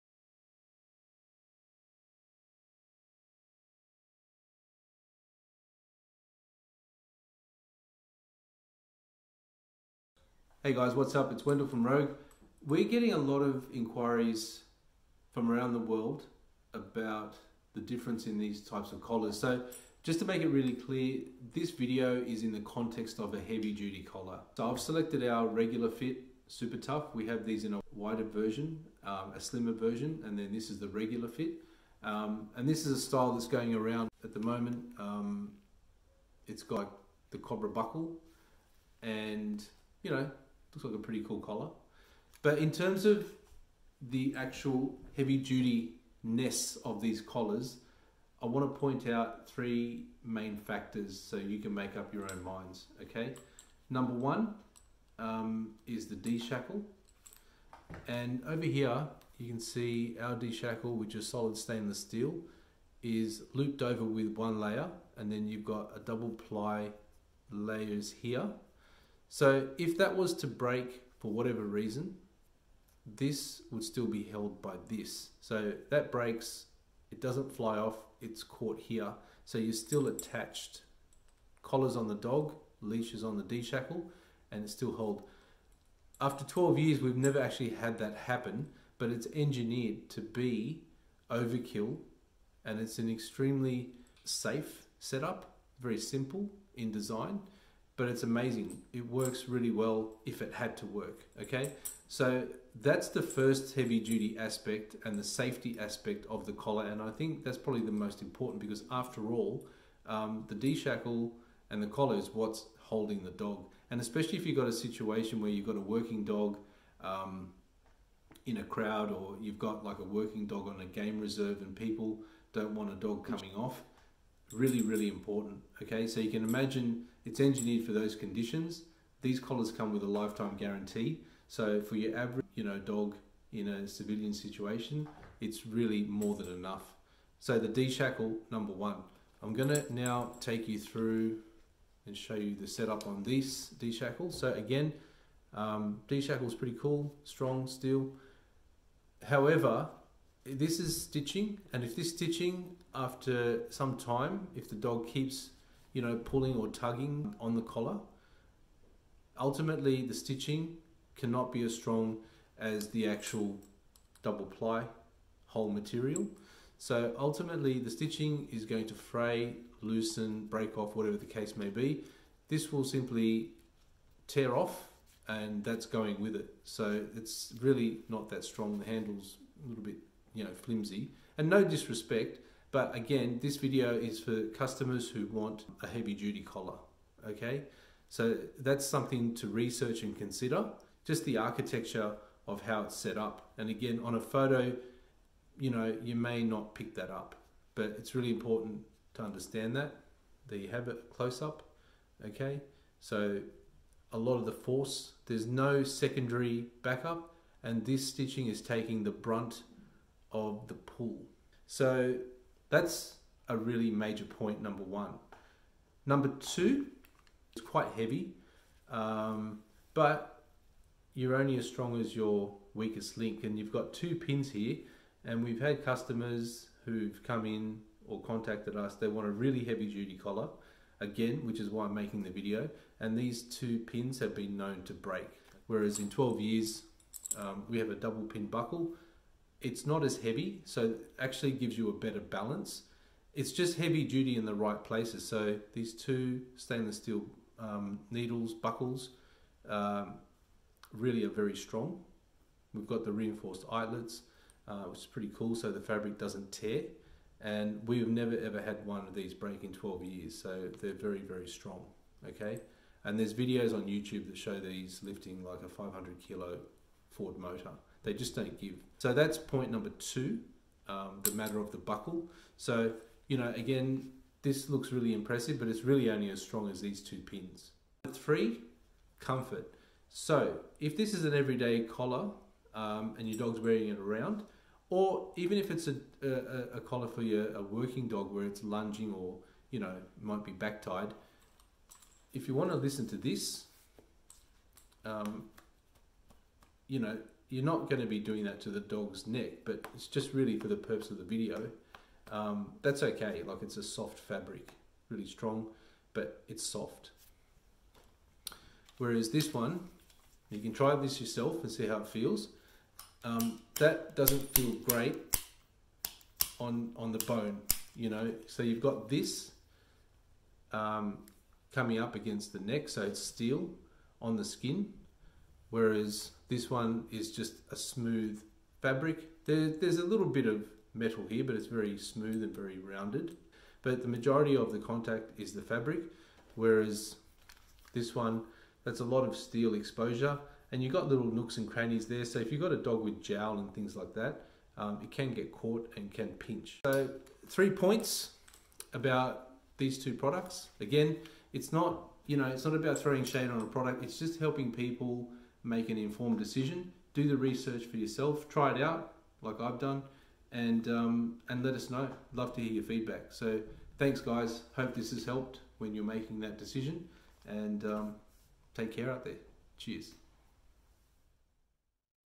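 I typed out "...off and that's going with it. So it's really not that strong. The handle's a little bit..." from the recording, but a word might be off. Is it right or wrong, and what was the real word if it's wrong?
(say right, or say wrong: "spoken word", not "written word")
right.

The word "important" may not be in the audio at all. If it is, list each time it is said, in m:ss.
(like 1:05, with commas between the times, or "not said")
1:48, 2:05, 3:18.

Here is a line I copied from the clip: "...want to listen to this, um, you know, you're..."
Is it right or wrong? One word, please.
right.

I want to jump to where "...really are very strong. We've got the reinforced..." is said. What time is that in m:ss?
4:10.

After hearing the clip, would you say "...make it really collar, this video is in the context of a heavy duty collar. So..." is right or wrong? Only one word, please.
wrong.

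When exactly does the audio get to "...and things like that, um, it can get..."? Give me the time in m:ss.
5:43.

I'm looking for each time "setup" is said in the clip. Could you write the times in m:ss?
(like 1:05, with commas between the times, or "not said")
1:34, 2:22.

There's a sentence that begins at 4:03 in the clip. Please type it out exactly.
It's just heavy duty in the right places.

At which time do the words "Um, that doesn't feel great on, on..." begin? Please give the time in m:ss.
5:13.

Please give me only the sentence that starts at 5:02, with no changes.
Um, that's okay, like it's a soft fabric, really strong, but it's soft.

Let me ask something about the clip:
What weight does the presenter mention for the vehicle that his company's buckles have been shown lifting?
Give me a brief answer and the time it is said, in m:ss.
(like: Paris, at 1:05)
500 kilos, at 4:25.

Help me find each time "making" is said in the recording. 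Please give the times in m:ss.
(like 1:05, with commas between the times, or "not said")
3:51, 6:06.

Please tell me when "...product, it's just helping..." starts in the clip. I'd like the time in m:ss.
5:53.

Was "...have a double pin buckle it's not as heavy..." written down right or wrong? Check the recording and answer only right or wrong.
right.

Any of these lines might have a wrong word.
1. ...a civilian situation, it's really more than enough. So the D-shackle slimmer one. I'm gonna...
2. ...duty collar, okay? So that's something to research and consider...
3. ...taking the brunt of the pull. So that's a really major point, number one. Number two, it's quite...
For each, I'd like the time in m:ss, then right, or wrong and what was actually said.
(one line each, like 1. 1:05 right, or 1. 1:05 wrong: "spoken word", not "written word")
1. 2:13 wrong: "number", not "slimmer"
2. 3:06 right
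3. 3:28 right.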